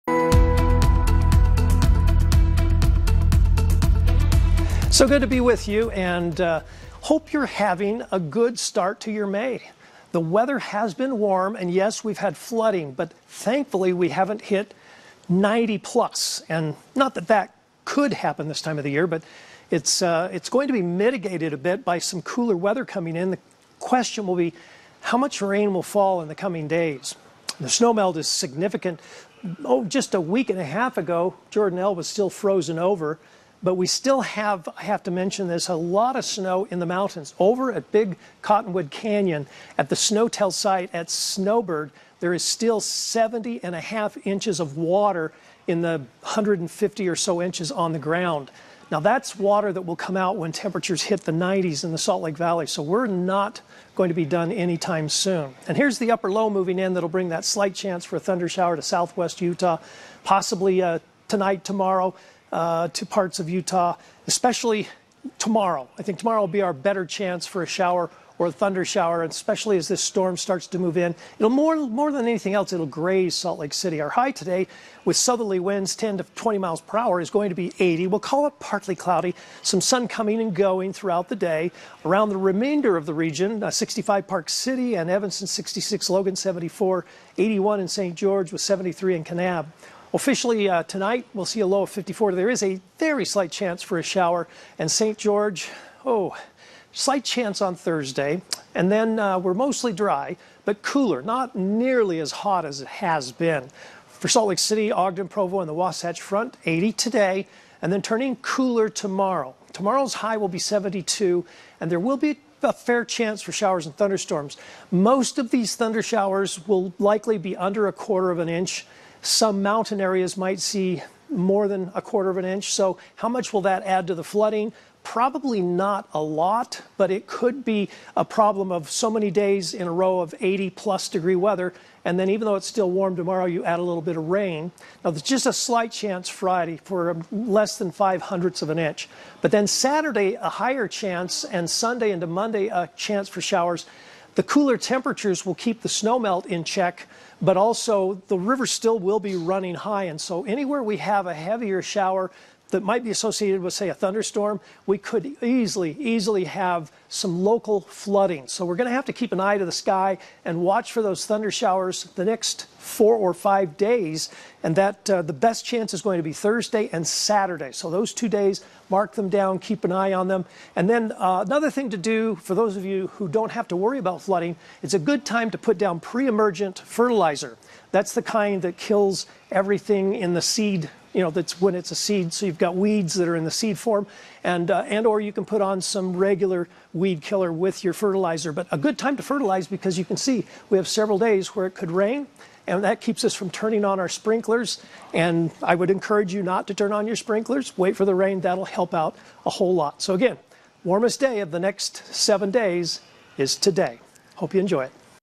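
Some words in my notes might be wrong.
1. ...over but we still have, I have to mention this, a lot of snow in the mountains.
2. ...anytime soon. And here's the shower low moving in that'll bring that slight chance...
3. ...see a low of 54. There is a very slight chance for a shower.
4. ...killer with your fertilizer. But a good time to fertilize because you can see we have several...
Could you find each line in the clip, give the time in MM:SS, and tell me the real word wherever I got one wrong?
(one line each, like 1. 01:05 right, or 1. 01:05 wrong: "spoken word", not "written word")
1. 00:32 right
2. 00:54 wrong: "upper", not "shower"
3. 01:31 right
4. 03:07 right.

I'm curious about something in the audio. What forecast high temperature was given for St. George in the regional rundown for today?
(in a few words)
81.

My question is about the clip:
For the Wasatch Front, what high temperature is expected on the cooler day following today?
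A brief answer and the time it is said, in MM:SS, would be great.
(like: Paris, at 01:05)
72, at 01:50.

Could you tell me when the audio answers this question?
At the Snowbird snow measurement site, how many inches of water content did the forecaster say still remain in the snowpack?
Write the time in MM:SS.
00:42.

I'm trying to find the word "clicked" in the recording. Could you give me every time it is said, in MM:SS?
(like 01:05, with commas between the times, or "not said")
not said.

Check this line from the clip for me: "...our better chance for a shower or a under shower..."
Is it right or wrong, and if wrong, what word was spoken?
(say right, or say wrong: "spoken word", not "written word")
wrong: "thunder", not "under".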